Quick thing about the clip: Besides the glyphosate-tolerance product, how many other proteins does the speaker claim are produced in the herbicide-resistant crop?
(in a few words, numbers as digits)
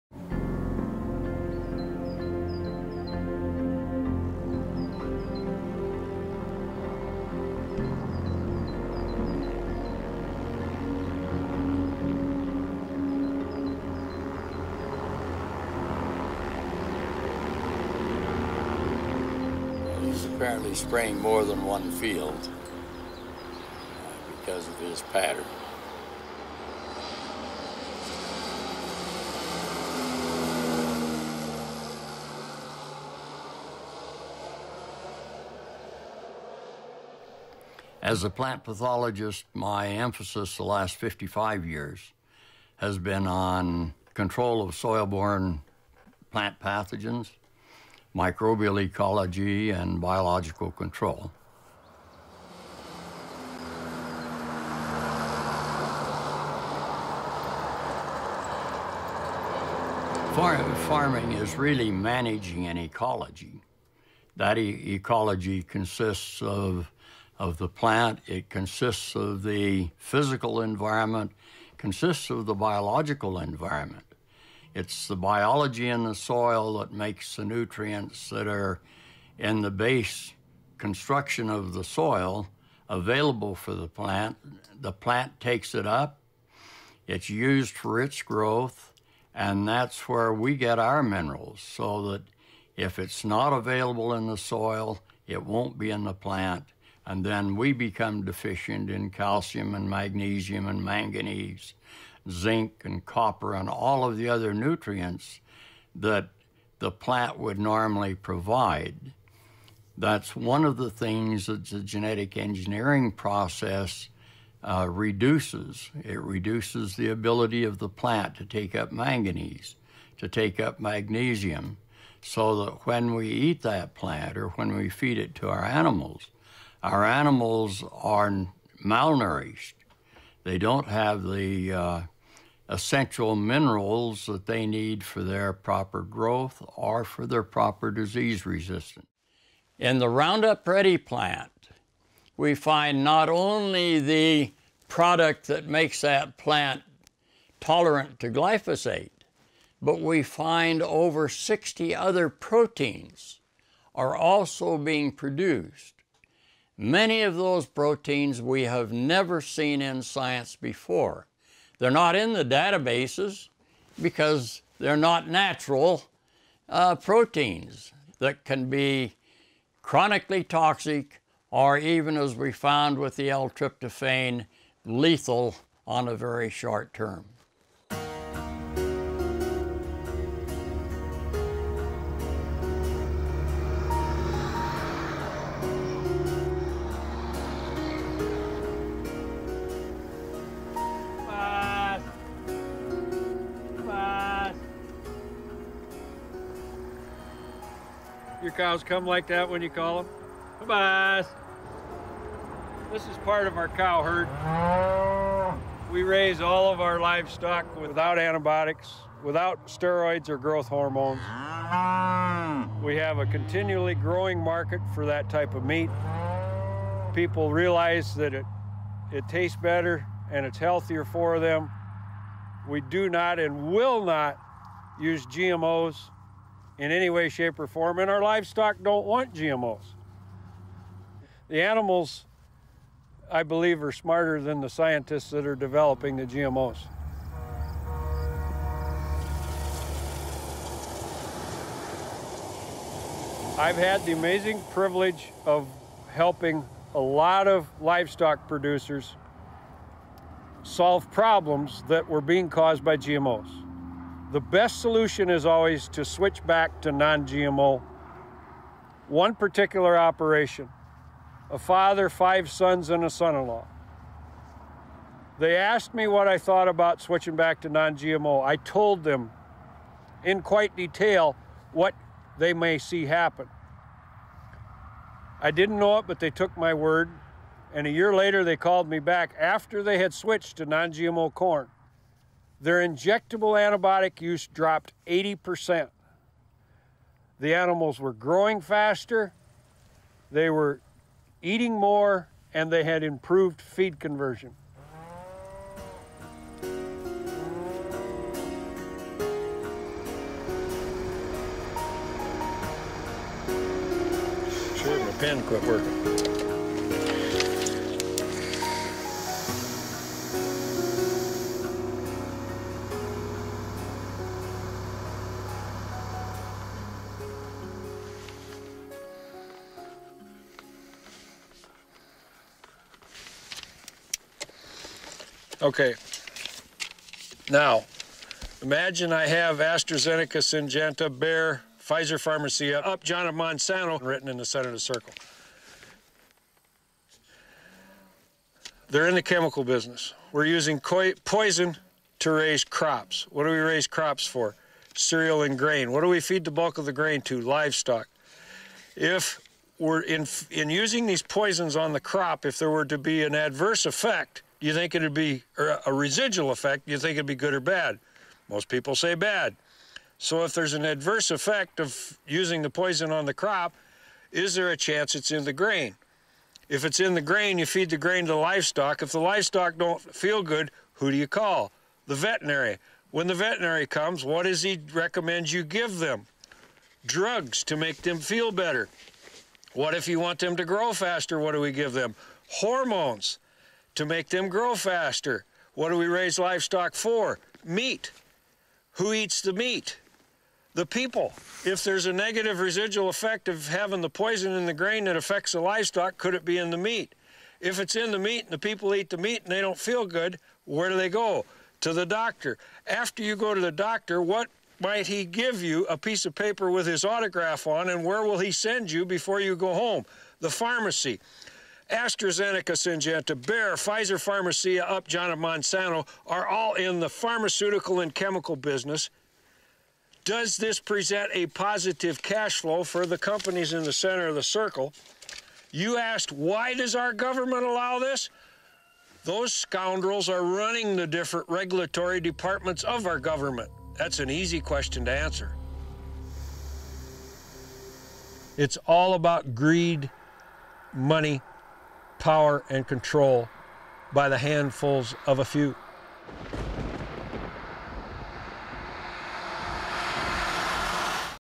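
over 60.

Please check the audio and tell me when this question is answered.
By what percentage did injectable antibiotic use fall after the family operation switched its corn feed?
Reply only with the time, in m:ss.
4:45.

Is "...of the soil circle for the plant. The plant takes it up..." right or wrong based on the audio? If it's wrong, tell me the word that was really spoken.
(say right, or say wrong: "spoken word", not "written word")
wrong: "available", not "circle".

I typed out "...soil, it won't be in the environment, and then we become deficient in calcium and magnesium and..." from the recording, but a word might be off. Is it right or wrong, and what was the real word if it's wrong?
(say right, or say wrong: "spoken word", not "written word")
wrong: "plant", not "environment".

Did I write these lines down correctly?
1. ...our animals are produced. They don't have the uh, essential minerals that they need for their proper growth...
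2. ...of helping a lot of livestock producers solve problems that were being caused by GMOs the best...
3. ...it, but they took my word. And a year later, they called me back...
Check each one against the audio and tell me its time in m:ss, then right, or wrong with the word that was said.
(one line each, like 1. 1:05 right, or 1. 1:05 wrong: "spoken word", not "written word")
1. 2:06 wrong: "malnourished", not "produced"
2. 4:05 right
3. 4:35 right.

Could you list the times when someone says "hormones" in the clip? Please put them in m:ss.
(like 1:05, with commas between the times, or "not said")
3:30, 6:22.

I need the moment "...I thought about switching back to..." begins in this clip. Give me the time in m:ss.
4:26.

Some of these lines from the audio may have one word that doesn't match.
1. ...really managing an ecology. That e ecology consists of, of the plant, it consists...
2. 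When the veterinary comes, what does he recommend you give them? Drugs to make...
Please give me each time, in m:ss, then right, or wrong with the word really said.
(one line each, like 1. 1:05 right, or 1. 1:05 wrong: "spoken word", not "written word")
1. 1:01 right
2. 6:13 right.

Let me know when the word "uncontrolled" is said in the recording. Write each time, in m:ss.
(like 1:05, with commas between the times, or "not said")
not said.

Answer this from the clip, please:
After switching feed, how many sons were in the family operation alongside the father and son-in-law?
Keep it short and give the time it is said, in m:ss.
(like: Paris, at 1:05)
5, at 4:22.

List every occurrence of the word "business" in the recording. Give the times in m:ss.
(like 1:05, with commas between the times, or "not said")
5:39, 6:58.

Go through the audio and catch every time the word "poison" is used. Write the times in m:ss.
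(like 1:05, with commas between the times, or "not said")
5:40, 5:51, 6:02, 6:34.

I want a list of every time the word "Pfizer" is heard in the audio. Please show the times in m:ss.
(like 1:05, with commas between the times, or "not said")
5:31, 6:53.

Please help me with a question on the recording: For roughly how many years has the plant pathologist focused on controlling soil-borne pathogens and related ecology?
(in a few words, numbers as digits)
55 years.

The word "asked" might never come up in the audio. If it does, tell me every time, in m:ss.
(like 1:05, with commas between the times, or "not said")
4:25, 7:05.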